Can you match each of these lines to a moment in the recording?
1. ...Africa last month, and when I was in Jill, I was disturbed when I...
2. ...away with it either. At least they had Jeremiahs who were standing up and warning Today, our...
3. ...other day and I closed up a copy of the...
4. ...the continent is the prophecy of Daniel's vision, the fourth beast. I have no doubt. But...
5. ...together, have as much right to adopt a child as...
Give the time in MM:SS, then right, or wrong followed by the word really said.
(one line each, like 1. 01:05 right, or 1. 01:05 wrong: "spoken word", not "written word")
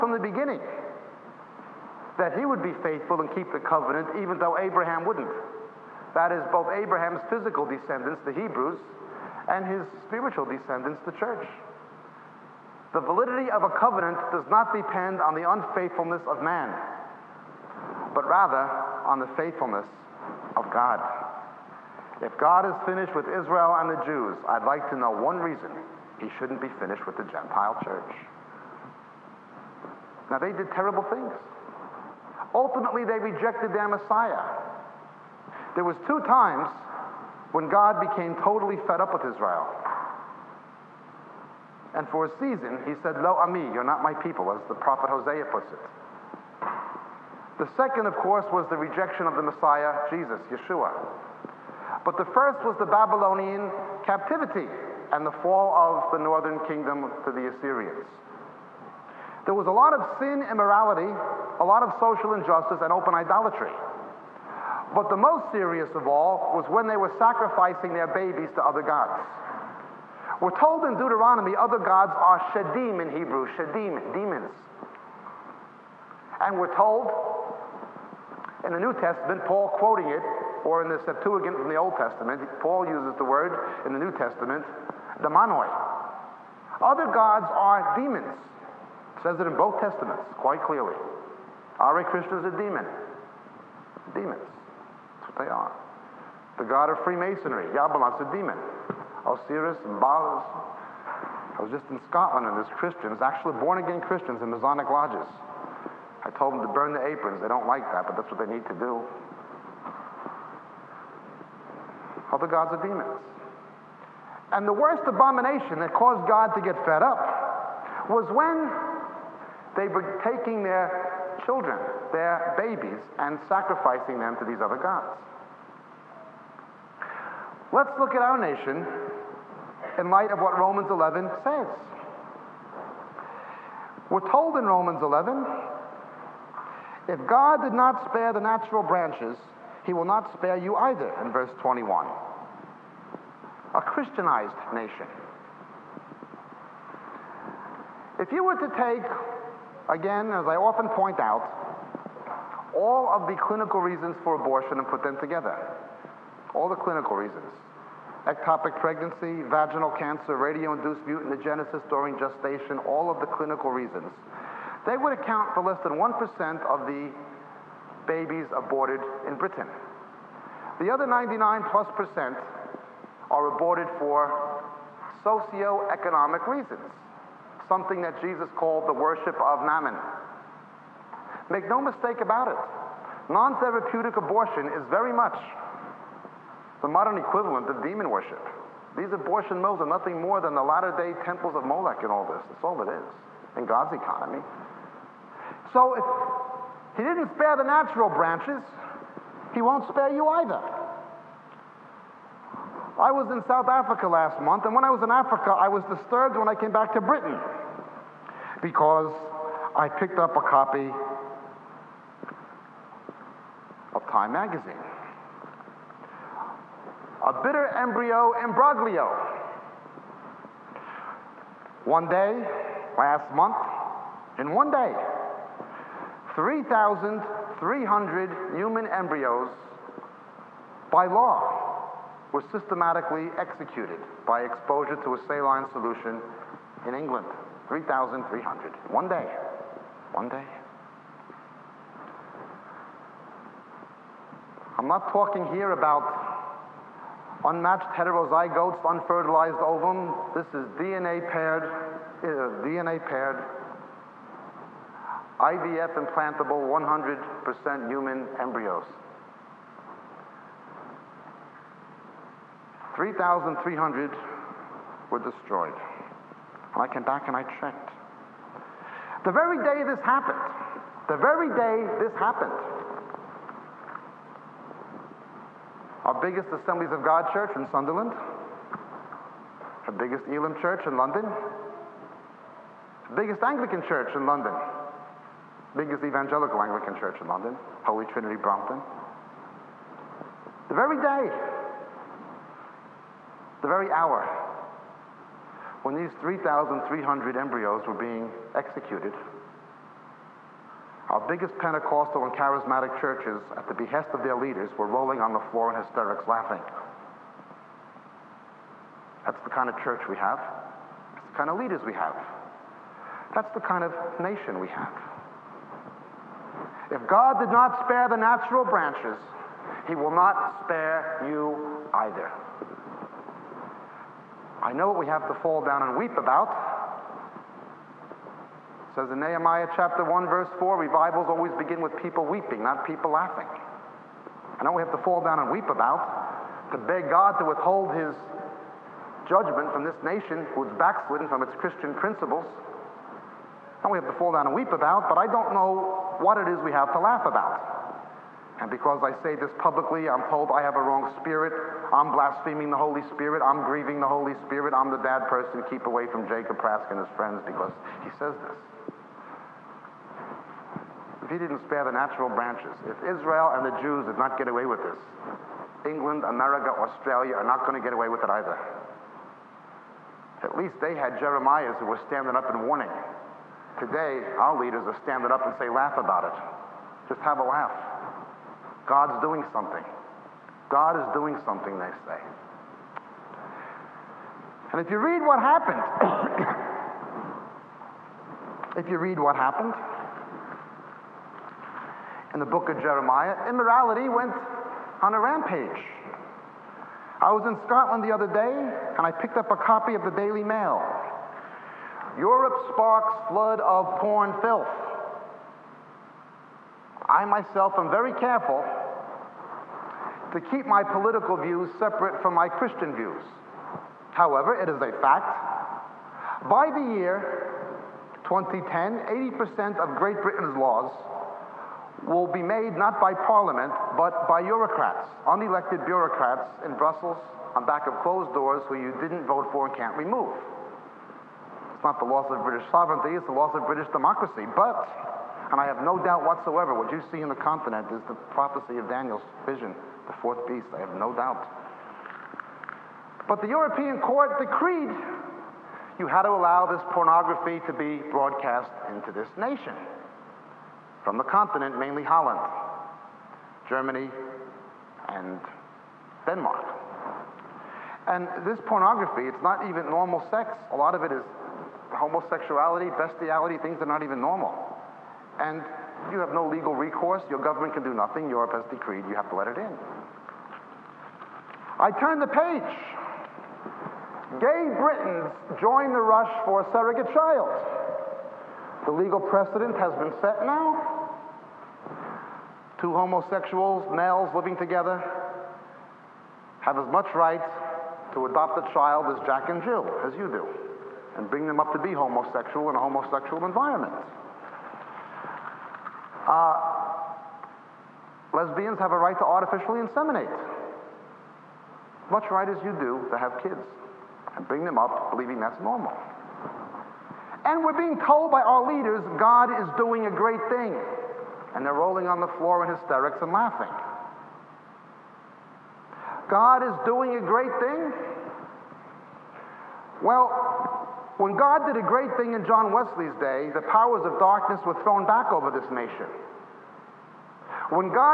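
1. 03:23 wrong: "Africa", not "Jill"
2. 06:07 right
3. 06:38 wrong: "picked", not "closed"
4. 07:17 right
5. 08:04 right.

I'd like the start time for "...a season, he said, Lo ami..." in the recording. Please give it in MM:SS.
00:42.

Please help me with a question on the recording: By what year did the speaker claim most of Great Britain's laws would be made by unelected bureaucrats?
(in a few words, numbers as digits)
2010.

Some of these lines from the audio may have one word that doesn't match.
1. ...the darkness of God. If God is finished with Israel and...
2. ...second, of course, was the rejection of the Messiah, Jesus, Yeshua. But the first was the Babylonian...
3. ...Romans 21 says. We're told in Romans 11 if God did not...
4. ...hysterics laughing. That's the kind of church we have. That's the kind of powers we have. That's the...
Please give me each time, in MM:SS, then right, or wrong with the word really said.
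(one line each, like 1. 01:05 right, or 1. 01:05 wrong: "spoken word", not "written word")
1. 00:19 wrong: "faithfulness", not "darkness"
2. 00:47 right
3. 02:10 wrong: "11", not "21"
4. 05:05 wrong: "leaders", not "powers".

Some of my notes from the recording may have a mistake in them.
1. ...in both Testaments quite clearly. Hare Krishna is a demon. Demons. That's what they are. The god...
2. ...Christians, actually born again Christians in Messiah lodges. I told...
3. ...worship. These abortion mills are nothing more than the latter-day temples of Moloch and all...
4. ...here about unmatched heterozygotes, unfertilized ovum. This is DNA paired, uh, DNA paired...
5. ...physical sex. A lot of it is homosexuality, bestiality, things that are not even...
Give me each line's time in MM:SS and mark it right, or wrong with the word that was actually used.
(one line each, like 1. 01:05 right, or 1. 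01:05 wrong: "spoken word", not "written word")
1. 01:29 right
2. 01:42 wrong: "Masonic", not "Messiah"
3. 03:08 right
4. 04:05 right
5. 07:39 wrong: "normal", not "physical".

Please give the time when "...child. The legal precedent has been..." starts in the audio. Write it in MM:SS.
07:57.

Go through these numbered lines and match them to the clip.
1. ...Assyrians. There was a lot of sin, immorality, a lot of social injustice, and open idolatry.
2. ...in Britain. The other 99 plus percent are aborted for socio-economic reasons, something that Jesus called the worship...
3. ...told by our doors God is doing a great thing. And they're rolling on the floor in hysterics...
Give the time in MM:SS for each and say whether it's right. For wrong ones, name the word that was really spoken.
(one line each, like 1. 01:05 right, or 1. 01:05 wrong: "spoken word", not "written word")
1. 00:57 right
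2. 02:49 right
3. 08:28 wrong: "leaders", not "doors".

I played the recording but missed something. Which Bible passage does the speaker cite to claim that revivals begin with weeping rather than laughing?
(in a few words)
Nehemiah 1:4.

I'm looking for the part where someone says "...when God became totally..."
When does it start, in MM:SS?
00:37.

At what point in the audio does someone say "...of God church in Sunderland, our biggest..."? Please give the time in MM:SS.
04:36.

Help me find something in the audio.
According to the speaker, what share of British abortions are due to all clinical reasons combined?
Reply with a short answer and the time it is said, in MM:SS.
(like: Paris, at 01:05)
less than 1%, at 02:45.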